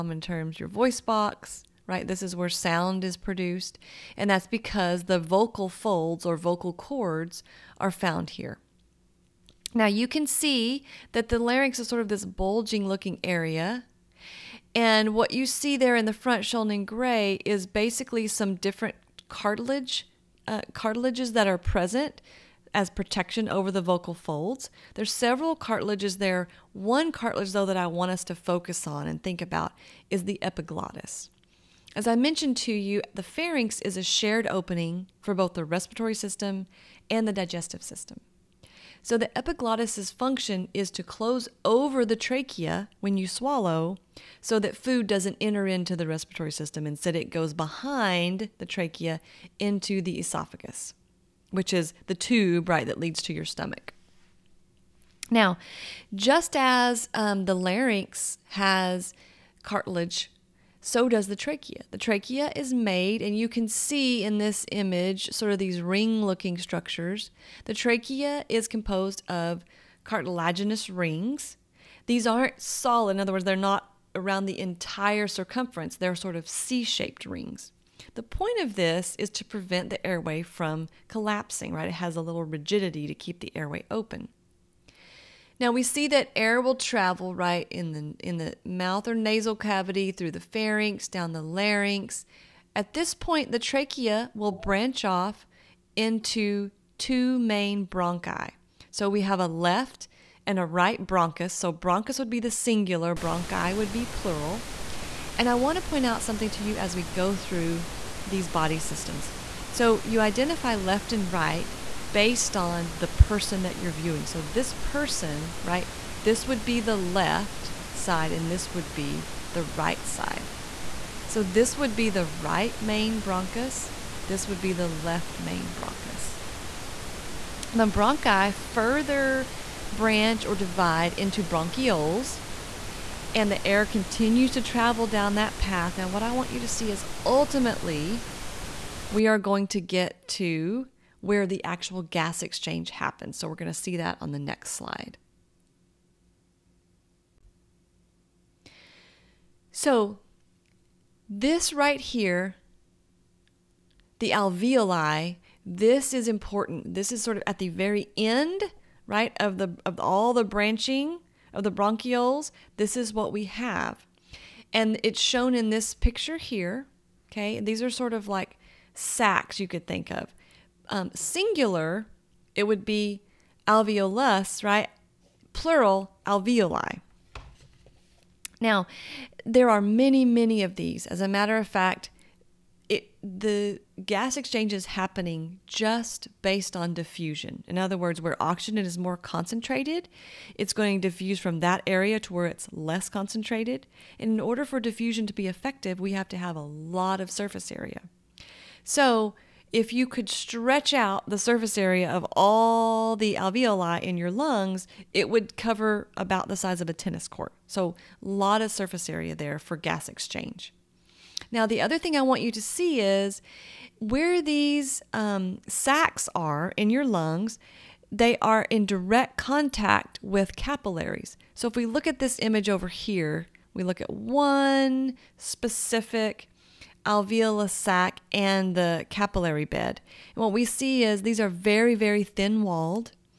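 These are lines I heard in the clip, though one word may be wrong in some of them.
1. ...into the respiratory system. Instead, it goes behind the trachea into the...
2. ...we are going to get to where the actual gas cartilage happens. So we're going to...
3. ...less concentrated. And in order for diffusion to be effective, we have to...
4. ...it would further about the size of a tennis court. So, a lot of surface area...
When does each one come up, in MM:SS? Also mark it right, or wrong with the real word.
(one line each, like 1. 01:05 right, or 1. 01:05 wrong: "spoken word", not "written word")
1. 00:45 right
2. 02:19 wrong: "exchange", not "cartilage"
3. 03:12 right
4. 03:25 wrong: "cover", not "further".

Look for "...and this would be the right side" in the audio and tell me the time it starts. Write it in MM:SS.
01:58.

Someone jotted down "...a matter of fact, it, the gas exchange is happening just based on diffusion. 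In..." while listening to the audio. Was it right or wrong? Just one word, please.
right.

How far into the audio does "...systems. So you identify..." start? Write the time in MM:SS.
01:48.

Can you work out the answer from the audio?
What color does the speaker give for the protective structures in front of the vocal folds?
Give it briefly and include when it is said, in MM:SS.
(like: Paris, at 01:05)
gray, at 00:16.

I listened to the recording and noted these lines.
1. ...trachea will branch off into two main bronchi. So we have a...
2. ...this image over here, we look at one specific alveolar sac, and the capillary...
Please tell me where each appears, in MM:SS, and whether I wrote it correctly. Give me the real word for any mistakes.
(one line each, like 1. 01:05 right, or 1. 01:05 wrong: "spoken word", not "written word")
1. 01:33 right
2. 03:42 right.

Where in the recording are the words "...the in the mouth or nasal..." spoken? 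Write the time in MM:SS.
01:27.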